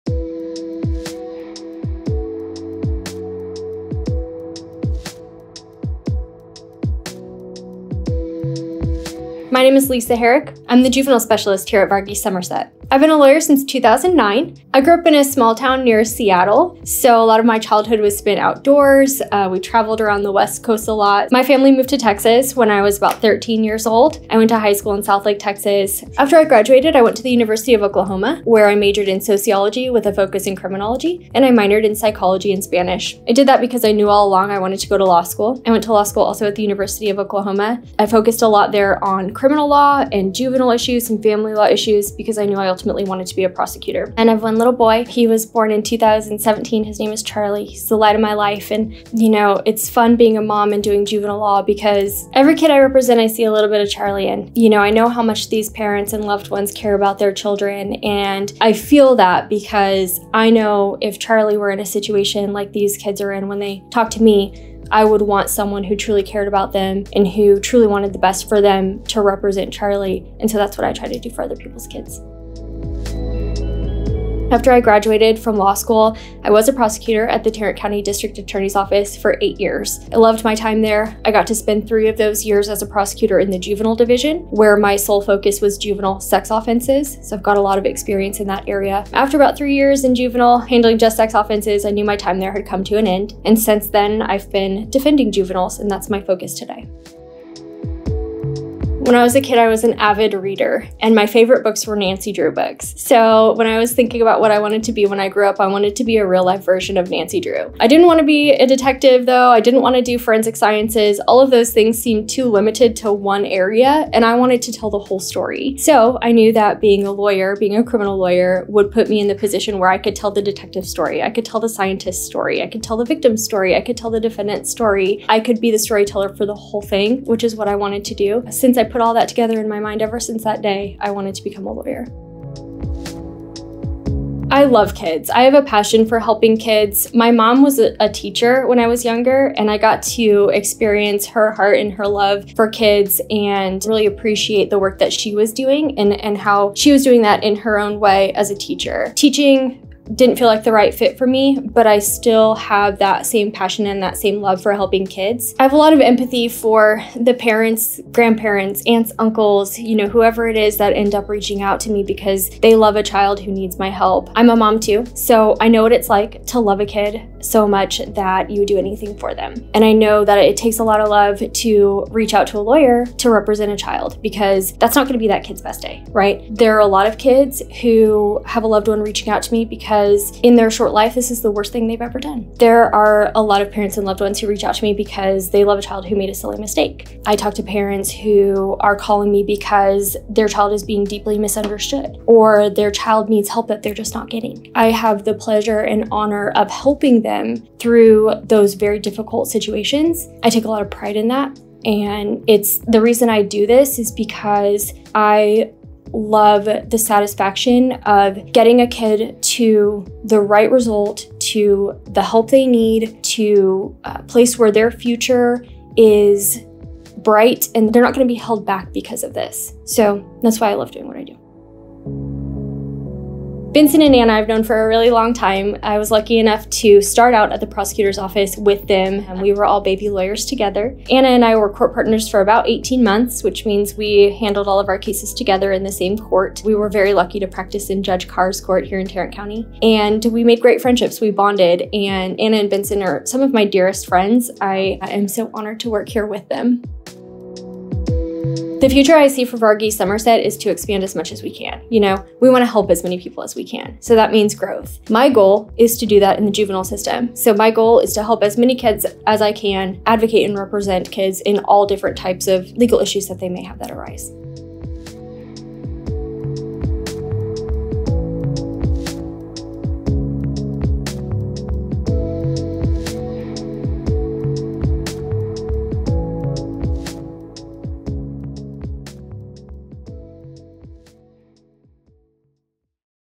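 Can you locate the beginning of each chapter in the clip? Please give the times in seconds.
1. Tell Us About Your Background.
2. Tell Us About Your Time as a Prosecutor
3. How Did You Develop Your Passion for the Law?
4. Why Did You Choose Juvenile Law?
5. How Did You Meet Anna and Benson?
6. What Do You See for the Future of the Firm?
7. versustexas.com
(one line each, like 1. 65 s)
1. 11 s
2. 82 s
3. 106 s
4. 141 s
5. 229 s
6. 255 s
7. 276 s.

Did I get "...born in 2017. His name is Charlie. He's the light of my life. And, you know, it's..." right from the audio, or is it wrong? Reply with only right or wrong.
right.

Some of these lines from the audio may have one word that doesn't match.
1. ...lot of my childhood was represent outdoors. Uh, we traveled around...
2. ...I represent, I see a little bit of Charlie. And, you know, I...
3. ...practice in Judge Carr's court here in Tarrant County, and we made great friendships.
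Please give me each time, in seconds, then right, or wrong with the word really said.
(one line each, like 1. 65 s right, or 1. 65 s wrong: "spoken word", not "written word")
1. 17 s wrong: "spent", not "represent"
2. 52 s right
3. 237 s right.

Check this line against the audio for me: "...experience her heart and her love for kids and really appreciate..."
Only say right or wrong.
right.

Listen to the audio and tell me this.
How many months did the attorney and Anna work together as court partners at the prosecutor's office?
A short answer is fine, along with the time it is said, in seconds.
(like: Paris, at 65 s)
18, at 232 s.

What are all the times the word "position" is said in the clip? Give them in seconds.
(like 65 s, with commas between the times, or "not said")
119 s.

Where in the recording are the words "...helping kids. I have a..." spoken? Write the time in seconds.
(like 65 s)
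154 s.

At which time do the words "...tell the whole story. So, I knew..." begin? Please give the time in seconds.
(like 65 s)
114 s.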